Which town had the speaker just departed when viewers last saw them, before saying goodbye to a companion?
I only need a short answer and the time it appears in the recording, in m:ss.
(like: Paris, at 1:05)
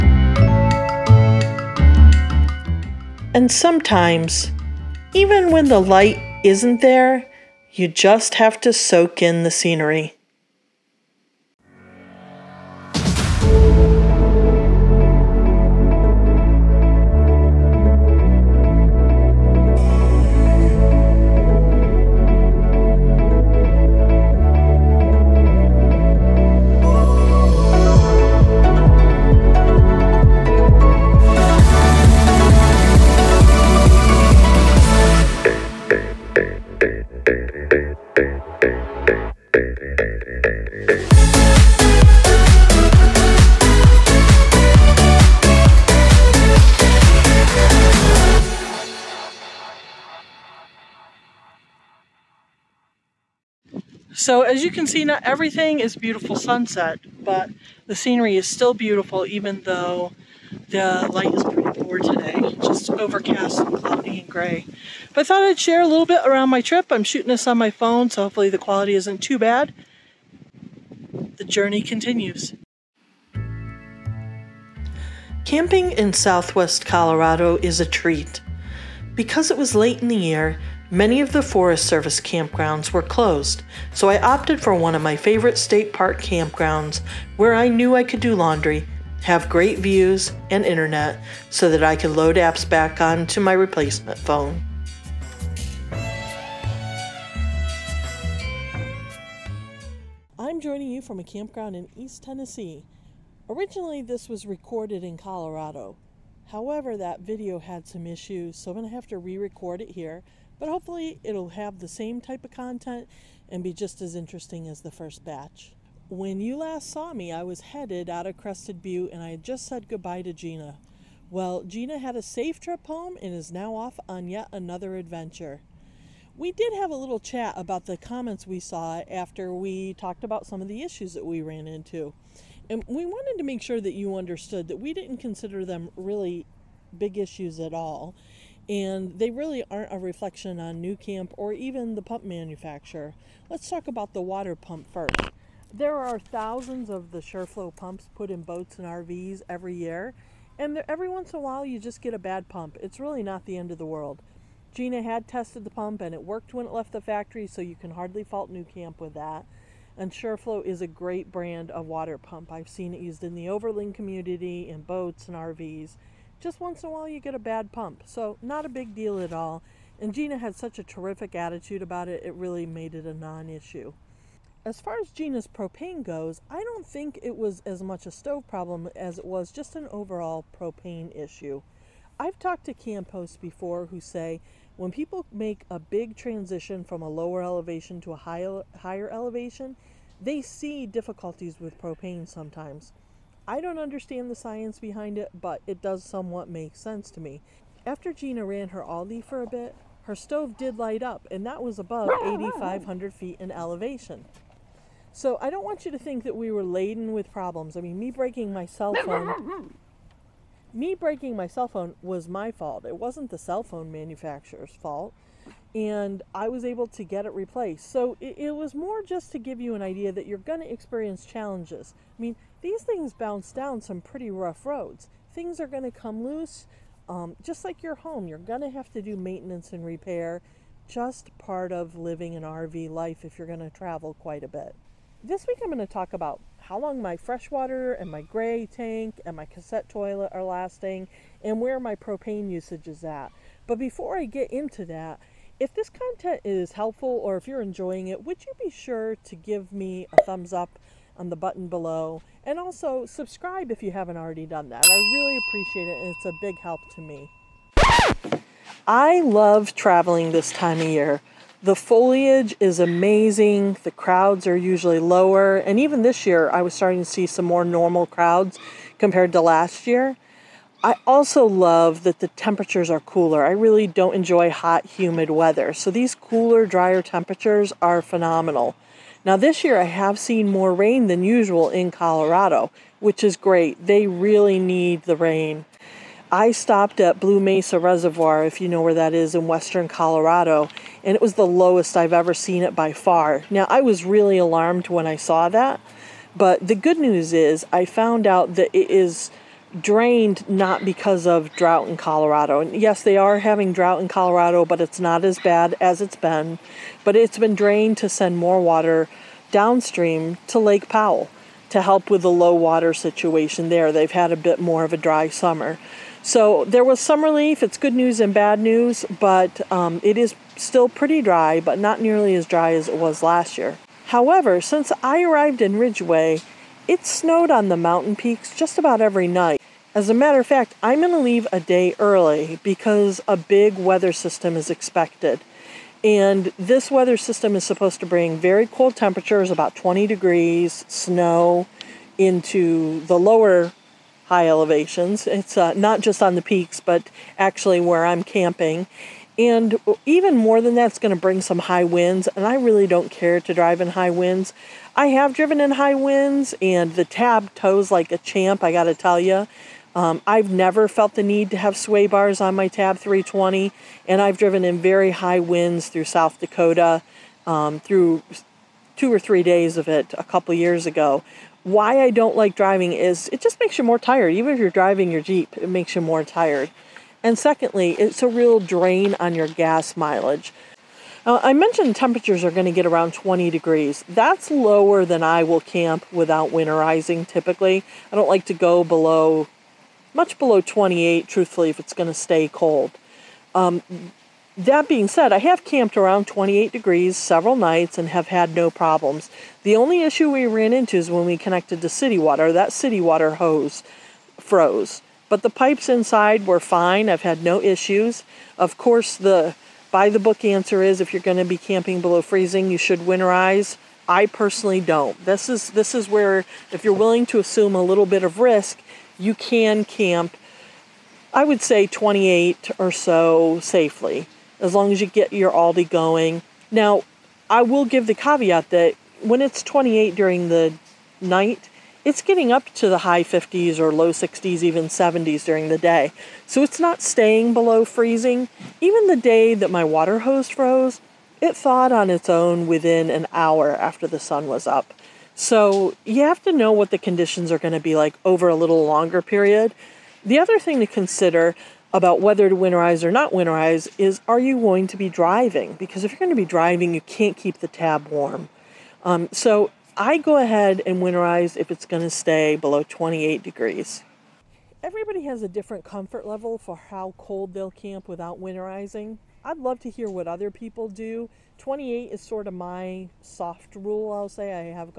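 Crested Butte, at 1:58.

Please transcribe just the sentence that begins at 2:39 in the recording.
And Shurflo is a great brand of water pump.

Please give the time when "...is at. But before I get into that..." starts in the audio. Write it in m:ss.
4:02.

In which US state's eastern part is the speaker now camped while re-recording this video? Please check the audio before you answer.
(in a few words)
Tennessee.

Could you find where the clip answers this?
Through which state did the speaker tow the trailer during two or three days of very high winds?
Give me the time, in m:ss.
6:06.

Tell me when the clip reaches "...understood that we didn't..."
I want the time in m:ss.
2:14.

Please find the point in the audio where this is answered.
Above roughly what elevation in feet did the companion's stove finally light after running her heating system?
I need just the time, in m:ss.
3:22.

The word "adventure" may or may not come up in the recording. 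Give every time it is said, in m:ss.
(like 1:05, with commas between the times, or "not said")
2:04.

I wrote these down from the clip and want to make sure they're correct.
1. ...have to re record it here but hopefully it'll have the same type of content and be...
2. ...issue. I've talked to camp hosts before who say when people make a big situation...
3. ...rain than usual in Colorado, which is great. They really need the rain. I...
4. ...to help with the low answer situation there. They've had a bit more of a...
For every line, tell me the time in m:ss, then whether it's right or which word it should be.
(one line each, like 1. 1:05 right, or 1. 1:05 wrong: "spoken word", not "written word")
1. 1:48 right
2. 3:01 wrong: "transition", not "situation"
3. 4:40 right
4. 5:11 wrong: "water", not "answer".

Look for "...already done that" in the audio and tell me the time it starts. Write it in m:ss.
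4:14.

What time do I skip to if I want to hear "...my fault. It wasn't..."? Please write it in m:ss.
3:32.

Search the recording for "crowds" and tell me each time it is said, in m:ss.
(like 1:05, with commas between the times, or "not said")
4:23, 4:28.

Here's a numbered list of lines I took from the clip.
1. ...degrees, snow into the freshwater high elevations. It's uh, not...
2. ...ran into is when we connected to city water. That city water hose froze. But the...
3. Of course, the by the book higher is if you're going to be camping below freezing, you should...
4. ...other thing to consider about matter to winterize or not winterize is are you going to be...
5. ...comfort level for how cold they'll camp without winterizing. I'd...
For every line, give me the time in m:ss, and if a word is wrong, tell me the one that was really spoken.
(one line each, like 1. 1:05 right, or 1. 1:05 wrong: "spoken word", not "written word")
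1. 5:40 wrong: "lower", not "freshwater"
2. 6:40 right
3. 6:48 wrong: "answer", not "higher"
4. 7:30 wrong: "whether", not "matter"
5. 7:45 right.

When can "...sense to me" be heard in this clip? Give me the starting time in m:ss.
3:16.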